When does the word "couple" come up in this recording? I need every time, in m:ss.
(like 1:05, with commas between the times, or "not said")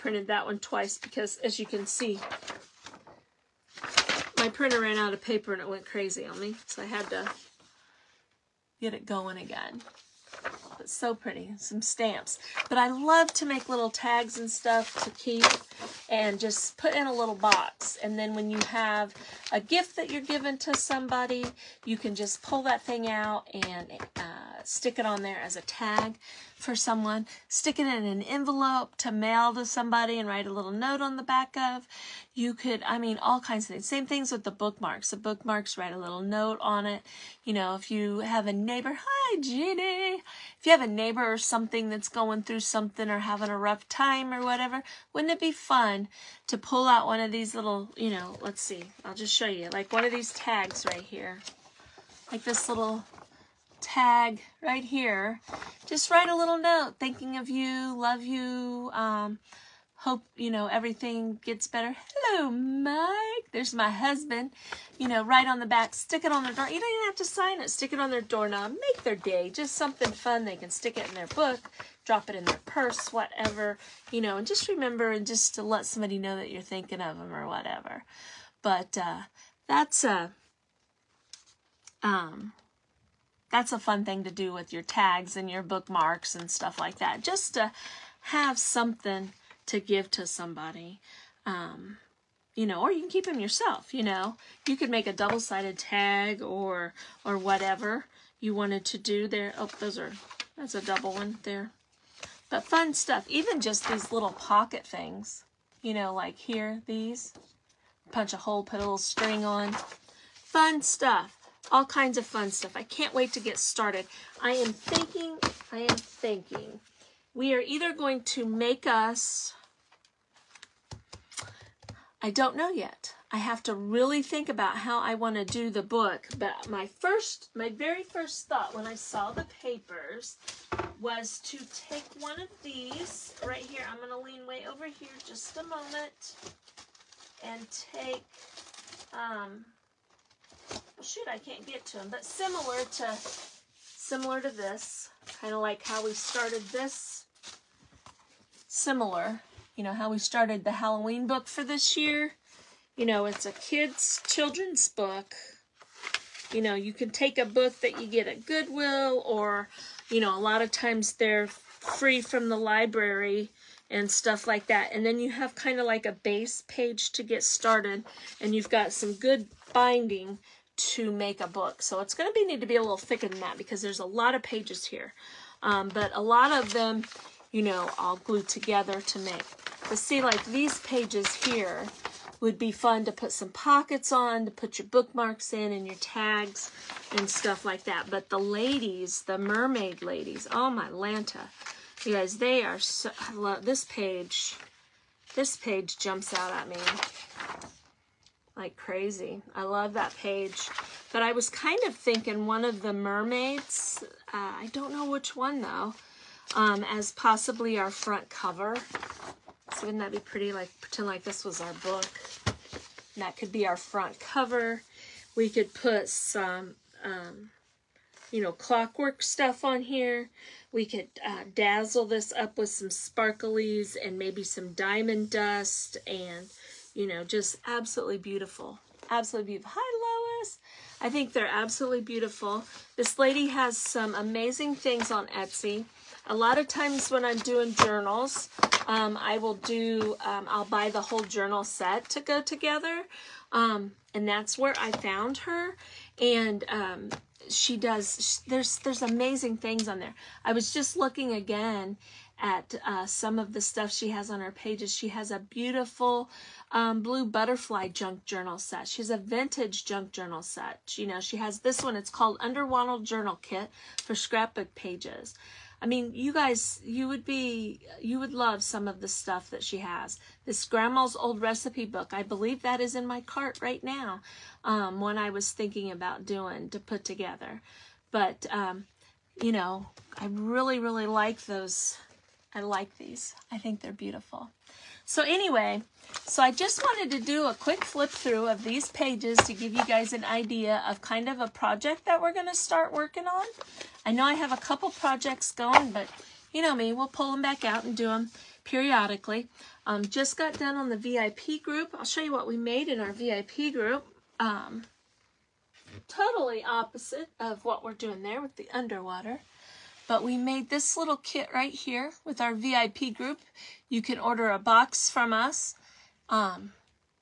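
4:54.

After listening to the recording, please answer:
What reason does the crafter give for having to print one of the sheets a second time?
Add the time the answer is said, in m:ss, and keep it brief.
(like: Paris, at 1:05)
Printer ran out of paper, at 0:04.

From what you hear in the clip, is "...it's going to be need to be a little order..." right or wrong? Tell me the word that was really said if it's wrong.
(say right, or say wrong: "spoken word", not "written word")
wrong: "thicker", not "order".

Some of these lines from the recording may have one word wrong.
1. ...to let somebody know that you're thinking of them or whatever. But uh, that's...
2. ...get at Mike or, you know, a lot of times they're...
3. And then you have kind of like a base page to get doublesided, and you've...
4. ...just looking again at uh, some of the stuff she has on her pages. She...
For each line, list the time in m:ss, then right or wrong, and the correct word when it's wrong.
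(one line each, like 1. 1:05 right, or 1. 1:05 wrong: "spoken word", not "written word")
1. 1:15 right
2. 2:38 wrong: "Goodwill", not "Mike"
3. 2:44 wrong: "started", not "doublesided"
4. 4:10 right.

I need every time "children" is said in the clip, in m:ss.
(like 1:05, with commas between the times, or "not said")
2:34.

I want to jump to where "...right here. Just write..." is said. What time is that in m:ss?
0:54.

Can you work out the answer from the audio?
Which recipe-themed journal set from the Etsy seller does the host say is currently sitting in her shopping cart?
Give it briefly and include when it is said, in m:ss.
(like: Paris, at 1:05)
Grandma's Old Recipe Book, at 4:30.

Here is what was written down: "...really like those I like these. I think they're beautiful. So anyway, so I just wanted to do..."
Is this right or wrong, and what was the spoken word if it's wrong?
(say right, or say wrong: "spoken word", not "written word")
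right.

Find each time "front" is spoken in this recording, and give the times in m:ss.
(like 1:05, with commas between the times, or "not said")
3:27, 3:33.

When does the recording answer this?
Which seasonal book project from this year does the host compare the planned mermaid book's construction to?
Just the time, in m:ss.
2:30.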